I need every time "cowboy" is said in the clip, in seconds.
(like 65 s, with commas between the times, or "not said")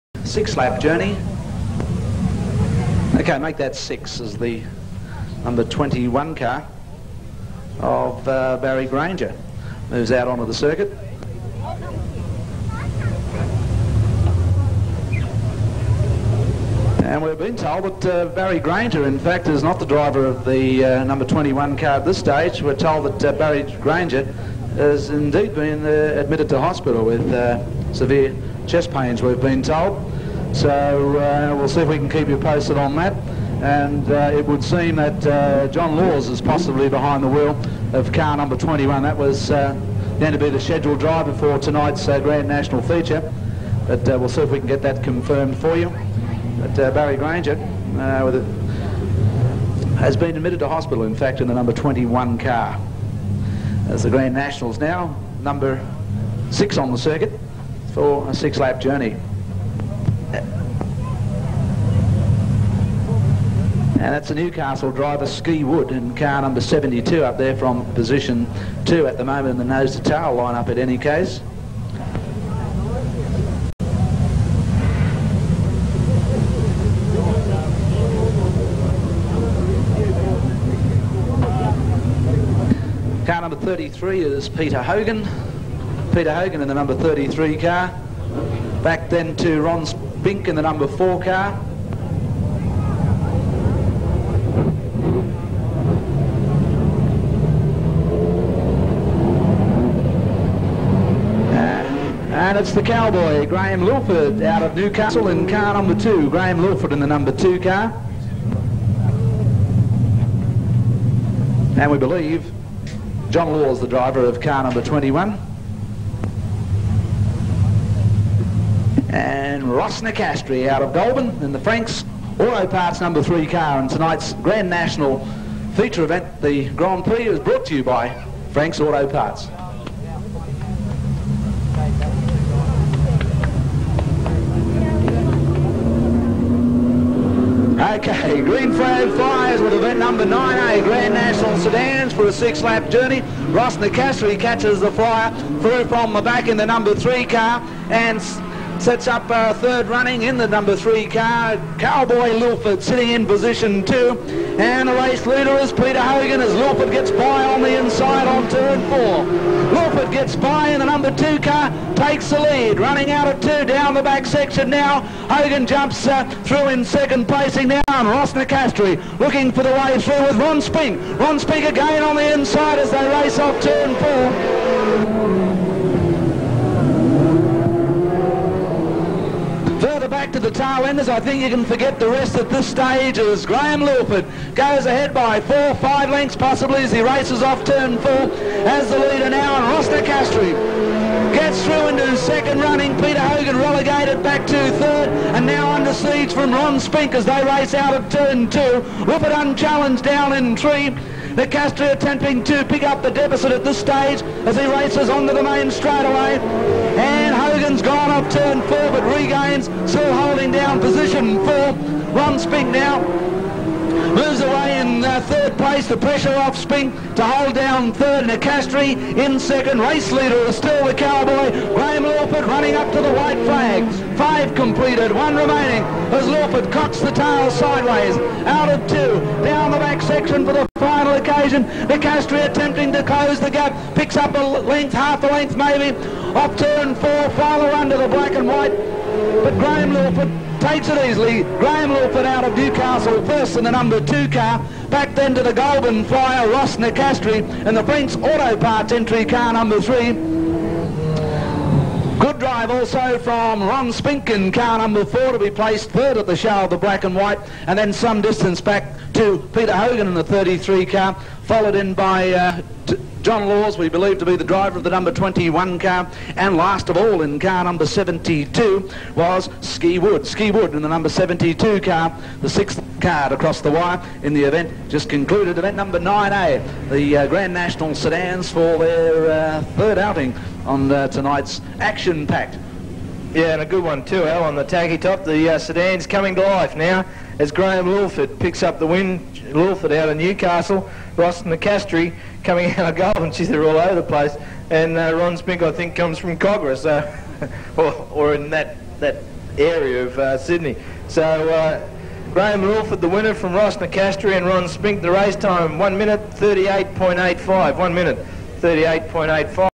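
102 s, 151 s, 220 s.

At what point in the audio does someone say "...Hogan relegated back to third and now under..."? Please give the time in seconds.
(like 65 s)
193 s.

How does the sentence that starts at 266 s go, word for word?
And last of all, in car number 72, was Ski Wood.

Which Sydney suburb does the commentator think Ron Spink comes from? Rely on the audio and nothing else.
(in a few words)
Kogarah.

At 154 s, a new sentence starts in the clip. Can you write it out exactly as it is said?
And the race leader is Peter Hogan as Lilford gets by on the inside on turn four.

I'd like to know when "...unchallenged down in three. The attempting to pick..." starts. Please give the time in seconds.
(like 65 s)
199 s.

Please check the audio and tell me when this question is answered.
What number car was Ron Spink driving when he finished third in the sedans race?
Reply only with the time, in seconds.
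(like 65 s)
254 s.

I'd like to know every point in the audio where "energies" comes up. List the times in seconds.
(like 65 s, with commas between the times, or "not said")
not said.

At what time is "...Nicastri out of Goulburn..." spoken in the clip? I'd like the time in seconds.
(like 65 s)
120 s.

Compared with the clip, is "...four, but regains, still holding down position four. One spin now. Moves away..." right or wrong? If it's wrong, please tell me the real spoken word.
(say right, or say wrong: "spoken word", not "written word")
right.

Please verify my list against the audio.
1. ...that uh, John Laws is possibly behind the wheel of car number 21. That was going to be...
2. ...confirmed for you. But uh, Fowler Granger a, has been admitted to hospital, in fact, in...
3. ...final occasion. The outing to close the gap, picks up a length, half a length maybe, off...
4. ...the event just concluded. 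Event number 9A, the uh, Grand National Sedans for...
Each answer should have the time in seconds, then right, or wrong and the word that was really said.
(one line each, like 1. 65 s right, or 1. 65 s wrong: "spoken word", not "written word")
1. 34 s right
2. 45 s wrong: "Barry", not "Fowler"
3. 230 s wrong: "attempting", not "outing"
4. 274 s right.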